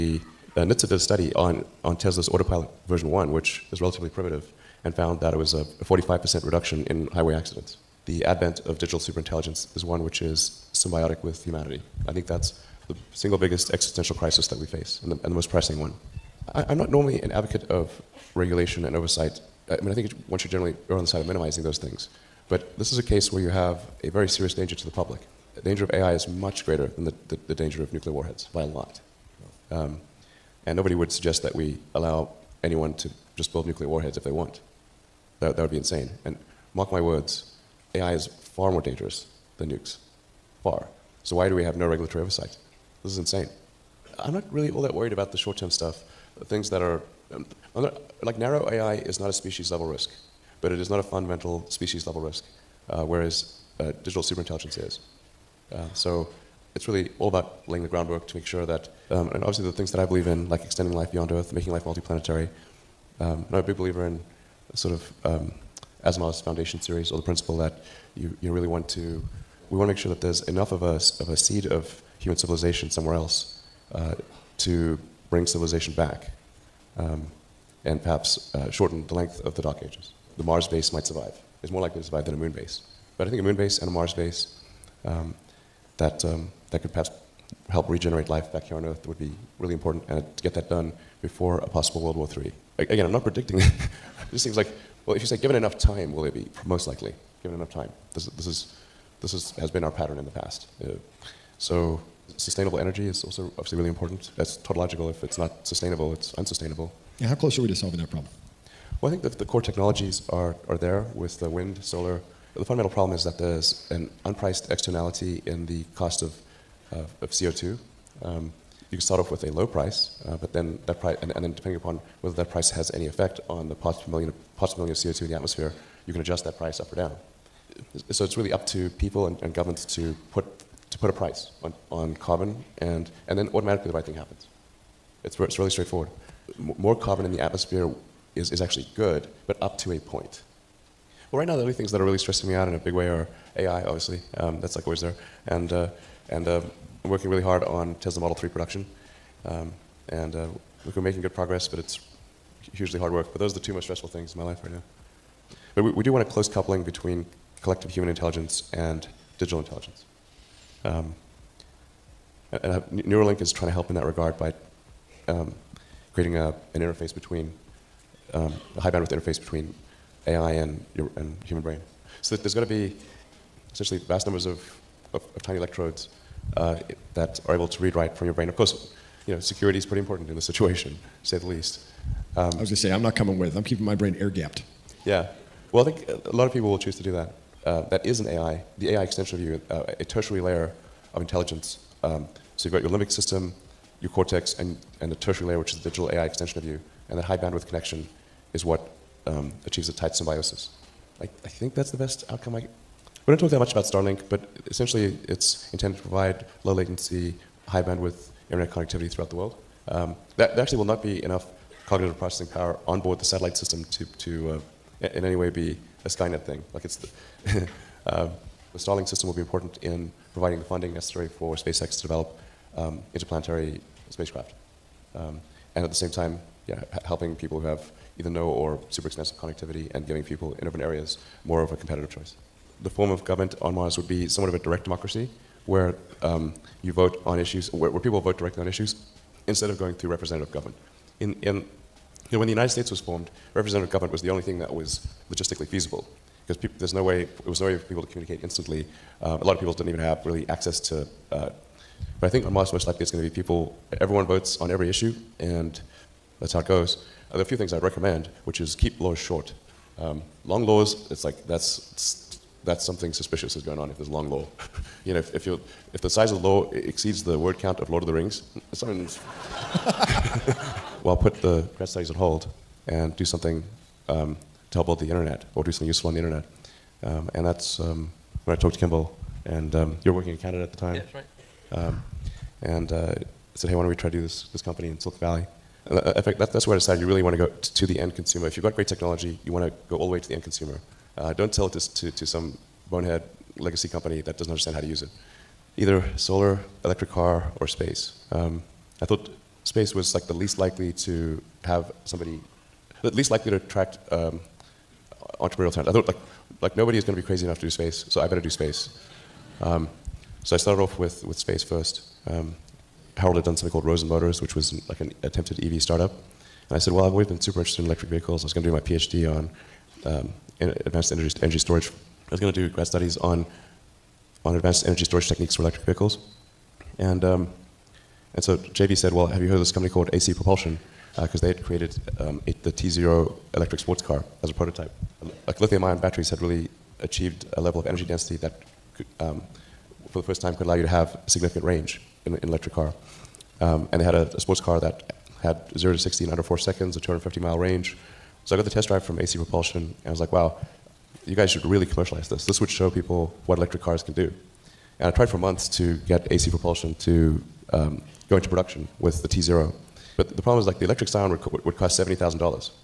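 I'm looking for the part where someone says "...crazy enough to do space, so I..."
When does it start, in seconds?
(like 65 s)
307 s.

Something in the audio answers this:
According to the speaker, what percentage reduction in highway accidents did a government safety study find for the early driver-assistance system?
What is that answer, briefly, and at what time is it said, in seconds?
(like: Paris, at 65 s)
45%, at 5 s.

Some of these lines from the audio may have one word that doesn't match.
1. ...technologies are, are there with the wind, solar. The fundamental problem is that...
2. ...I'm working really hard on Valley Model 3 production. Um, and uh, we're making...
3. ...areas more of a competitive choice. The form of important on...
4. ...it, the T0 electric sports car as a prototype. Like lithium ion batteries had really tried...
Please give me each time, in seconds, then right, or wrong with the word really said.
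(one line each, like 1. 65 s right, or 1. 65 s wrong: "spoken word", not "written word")
1. 109 s right
2. 147 s wrong: "Tesla", not "Valley"
3. 230 s wrong: "government", not "important"
4. 332 s wrong: "achieved", not "tried".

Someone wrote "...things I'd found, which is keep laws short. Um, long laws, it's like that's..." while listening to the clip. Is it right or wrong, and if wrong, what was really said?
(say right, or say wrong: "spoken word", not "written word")
wrong: "recommend", not "found".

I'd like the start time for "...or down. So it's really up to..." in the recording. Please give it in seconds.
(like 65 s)
126 s.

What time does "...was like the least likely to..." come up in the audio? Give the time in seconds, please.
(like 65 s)
299 s.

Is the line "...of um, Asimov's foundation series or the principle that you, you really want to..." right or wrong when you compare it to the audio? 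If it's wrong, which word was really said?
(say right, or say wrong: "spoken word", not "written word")
right.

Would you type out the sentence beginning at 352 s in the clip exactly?
This would show people what electric cars can do.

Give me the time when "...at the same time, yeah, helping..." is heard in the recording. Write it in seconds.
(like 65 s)
225 s.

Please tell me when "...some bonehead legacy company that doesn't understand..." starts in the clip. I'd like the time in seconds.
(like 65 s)
292 s.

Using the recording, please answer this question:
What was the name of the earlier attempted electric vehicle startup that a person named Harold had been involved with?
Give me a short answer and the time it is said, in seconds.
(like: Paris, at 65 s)
Rosen Motors, at 313 s.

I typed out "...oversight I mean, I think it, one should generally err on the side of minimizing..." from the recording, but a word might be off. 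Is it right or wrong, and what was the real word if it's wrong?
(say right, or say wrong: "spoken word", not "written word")
right.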